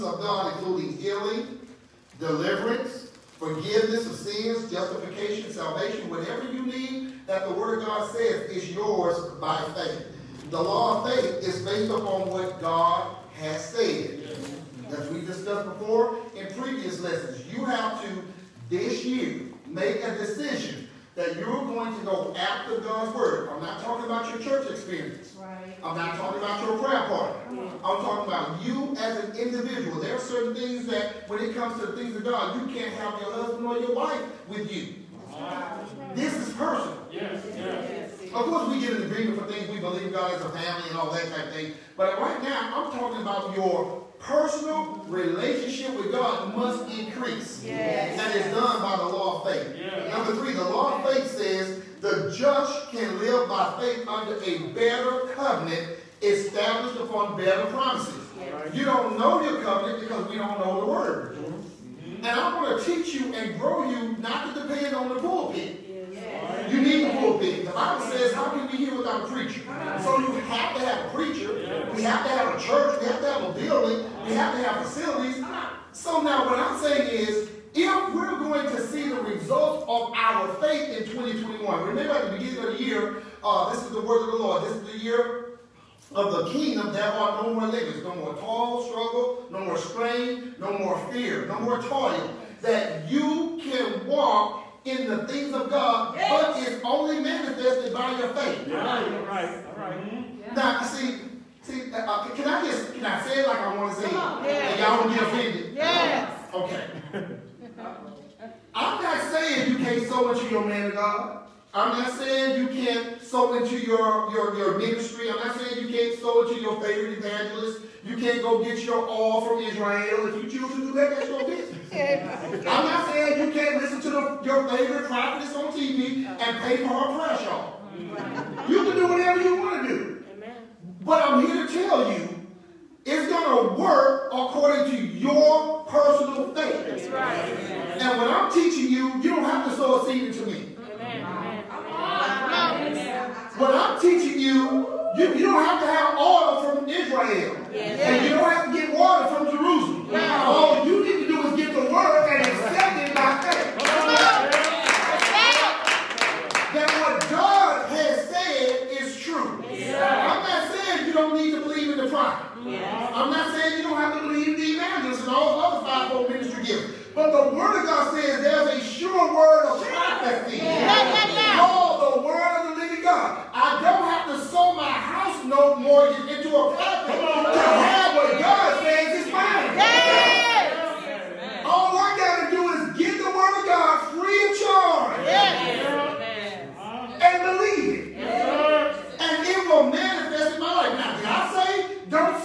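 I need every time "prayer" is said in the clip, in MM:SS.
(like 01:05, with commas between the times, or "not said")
00:26, 02:07.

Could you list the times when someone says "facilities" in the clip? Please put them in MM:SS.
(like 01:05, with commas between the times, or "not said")
01:14.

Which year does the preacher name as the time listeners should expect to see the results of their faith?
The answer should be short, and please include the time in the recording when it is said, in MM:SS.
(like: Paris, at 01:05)
2021, at 01:21.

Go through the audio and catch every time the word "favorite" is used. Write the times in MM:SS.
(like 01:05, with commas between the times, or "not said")
01:56, 02:04.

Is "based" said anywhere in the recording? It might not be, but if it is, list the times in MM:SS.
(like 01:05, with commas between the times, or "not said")
00:11.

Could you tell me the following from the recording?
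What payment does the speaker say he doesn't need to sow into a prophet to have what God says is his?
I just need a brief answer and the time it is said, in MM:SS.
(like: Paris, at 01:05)
house note mortgage, at 02:54.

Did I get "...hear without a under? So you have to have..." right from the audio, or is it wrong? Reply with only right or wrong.
wrong.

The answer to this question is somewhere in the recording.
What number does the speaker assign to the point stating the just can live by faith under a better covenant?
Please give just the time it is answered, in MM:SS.
00:50.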